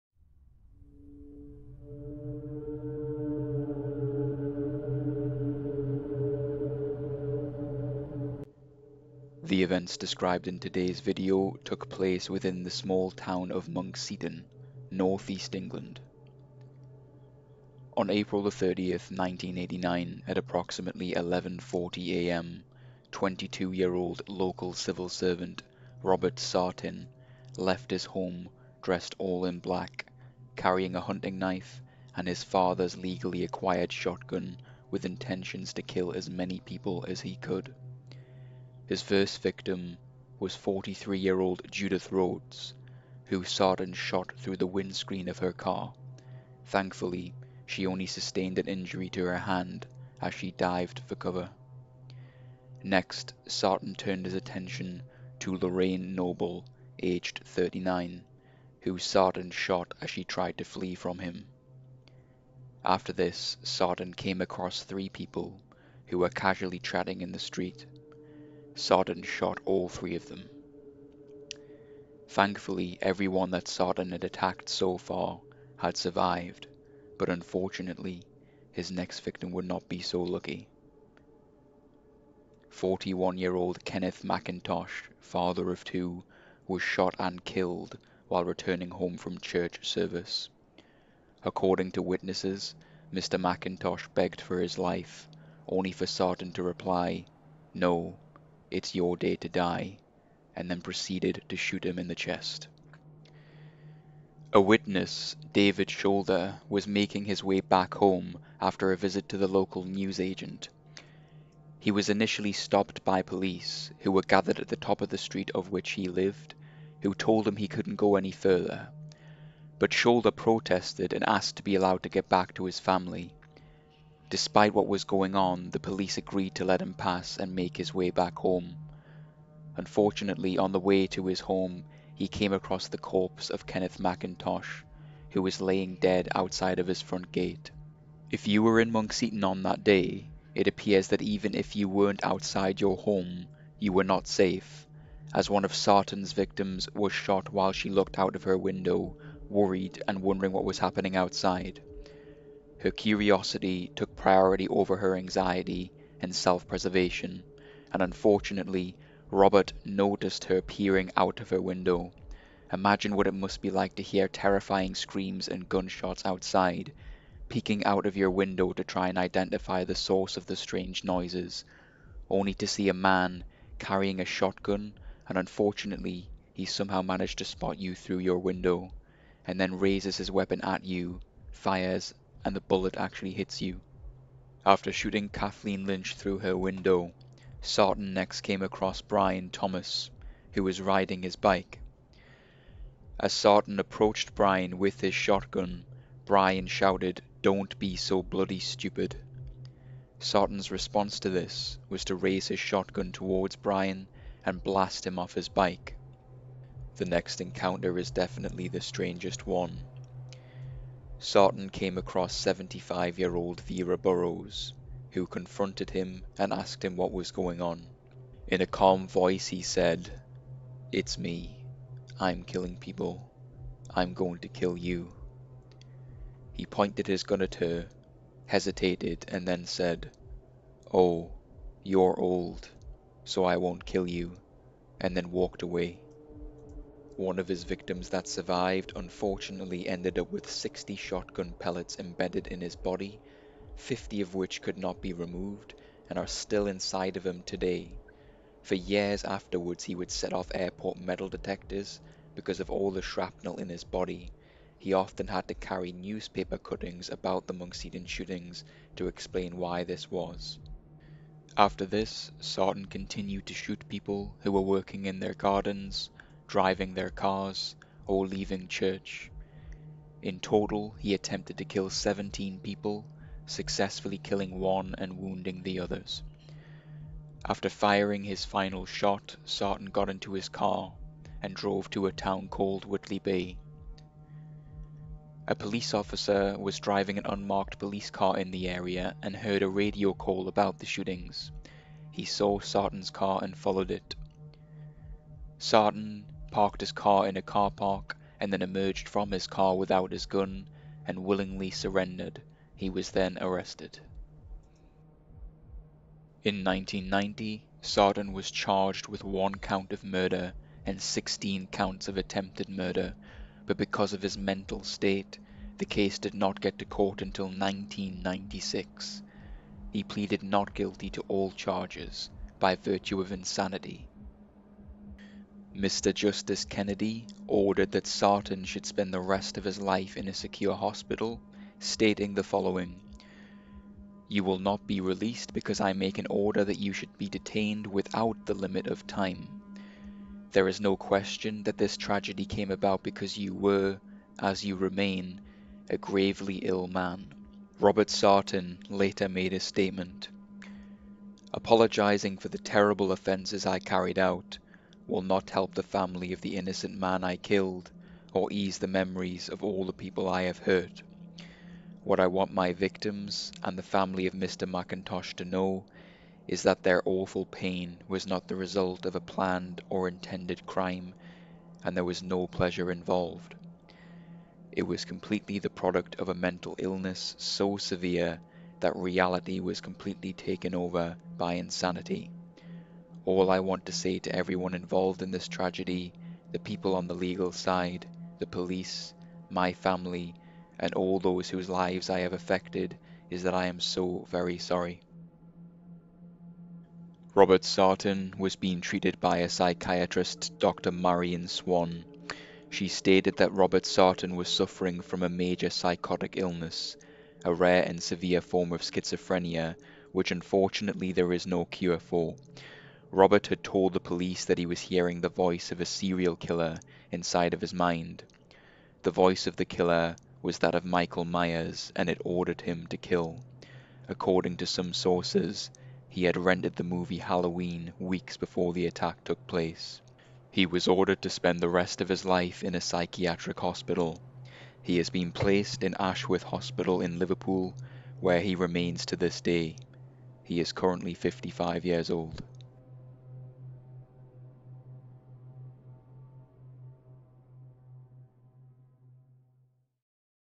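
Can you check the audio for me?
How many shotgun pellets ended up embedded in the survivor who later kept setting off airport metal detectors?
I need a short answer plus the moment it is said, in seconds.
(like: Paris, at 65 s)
60, at 240 s.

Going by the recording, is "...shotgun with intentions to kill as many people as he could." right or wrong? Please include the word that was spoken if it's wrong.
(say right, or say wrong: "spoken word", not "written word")
right.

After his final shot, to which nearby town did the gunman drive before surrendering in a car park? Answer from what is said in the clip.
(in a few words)
Whitley Bay.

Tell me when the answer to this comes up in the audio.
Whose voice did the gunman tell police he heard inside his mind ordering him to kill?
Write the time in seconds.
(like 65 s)
420 s.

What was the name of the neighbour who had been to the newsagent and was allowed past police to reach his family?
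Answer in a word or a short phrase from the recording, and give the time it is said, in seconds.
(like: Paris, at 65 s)
David Shoulder, at 105 s.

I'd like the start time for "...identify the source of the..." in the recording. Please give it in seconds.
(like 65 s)
169 s.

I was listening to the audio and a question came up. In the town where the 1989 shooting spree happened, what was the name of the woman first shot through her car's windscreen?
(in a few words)
Judith Rhodes.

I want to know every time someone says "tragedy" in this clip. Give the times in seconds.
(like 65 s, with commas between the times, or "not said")
341 s, 385 s.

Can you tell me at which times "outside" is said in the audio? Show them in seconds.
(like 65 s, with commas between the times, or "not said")
136 s, 142 s, 151 s, 166 s.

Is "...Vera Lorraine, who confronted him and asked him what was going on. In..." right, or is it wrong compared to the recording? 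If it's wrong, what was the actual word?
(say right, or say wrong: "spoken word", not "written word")
wrong: "Burrows", not "Lorraine".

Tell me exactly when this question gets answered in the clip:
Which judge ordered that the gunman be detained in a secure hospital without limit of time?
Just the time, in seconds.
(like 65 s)
325 s.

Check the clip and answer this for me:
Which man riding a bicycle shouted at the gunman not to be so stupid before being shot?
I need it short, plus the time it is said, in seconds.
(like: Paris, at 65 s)
Brian Thomas, at 189 s.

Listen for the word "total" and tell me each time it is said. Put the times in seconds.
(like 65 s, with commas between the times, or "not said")
270 s.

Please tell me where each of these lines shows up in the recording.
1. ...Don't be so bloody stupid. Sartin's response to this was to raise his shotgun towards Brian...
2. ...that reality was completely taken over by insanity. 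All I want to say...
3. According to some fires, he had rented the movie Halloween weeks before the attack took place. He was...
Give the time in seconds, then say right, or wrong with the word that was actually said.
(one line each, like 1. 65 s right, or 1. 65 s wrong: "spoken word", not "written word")
1. 197 s right
2. 378 s right
3. 424 s wrong: "sources", not "fires".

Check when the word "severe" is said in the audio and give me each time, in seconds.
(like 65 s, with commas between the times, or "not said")
377 s, 408 s.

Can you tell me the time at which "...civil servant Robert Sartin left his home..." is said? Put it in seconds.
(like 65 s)
24 s.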